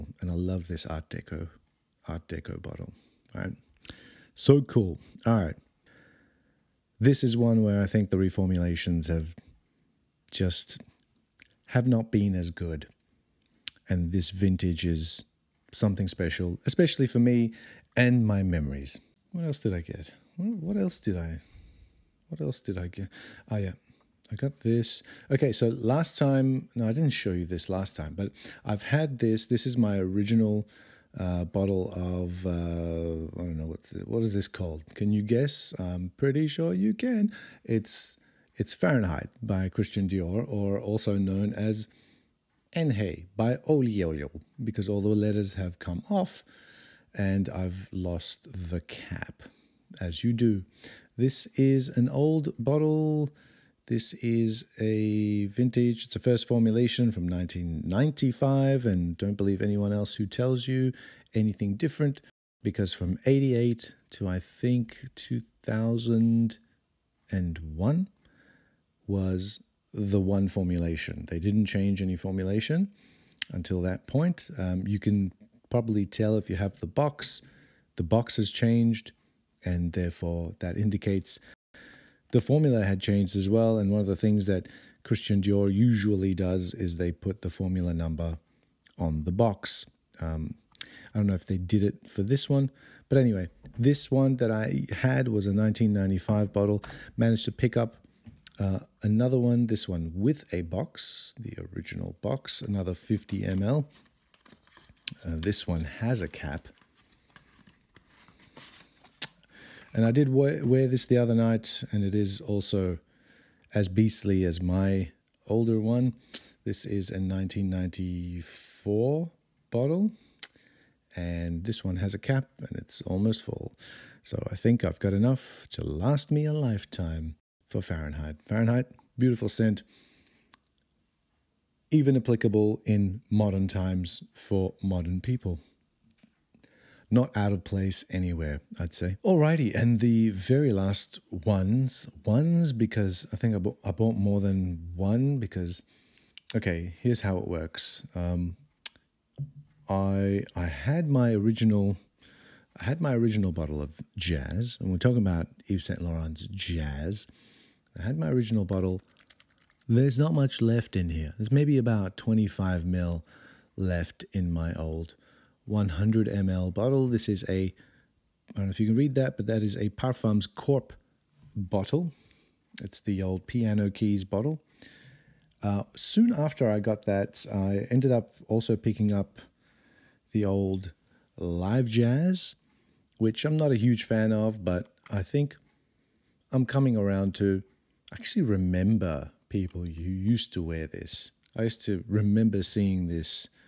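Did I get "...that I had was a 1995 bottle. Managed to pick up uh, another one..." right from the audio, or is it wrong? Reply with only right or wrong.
right.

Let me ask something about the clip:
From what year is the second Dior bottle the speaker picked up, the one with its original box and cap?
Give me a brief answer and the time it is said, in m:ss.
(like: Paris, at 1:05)
1994, at 1:57.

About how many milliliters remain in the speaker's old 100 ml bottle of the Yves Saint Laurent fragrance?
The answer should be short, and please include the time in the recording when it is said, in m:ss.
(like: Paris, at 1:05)
25 ml, at 2:42.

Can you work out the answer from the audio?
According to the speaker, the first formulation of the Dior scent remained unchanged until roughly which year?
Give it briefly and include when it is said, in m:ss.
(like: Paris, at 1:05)
2001, at 1:05.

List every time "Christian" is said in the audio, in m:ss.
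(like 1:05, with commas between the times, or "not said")
0:39, 1:25.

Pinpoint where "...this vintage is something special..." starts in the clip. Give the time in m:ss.
0:14.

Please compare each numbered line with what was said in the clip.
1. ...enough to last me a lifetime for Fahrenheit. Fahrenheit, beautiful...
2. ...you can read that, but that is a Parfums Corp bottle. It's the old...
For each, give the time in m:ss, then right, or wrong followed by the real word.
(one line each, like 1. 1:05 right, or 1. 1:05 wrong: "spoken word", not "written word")
1. 2:05 right
2. 2:48 right.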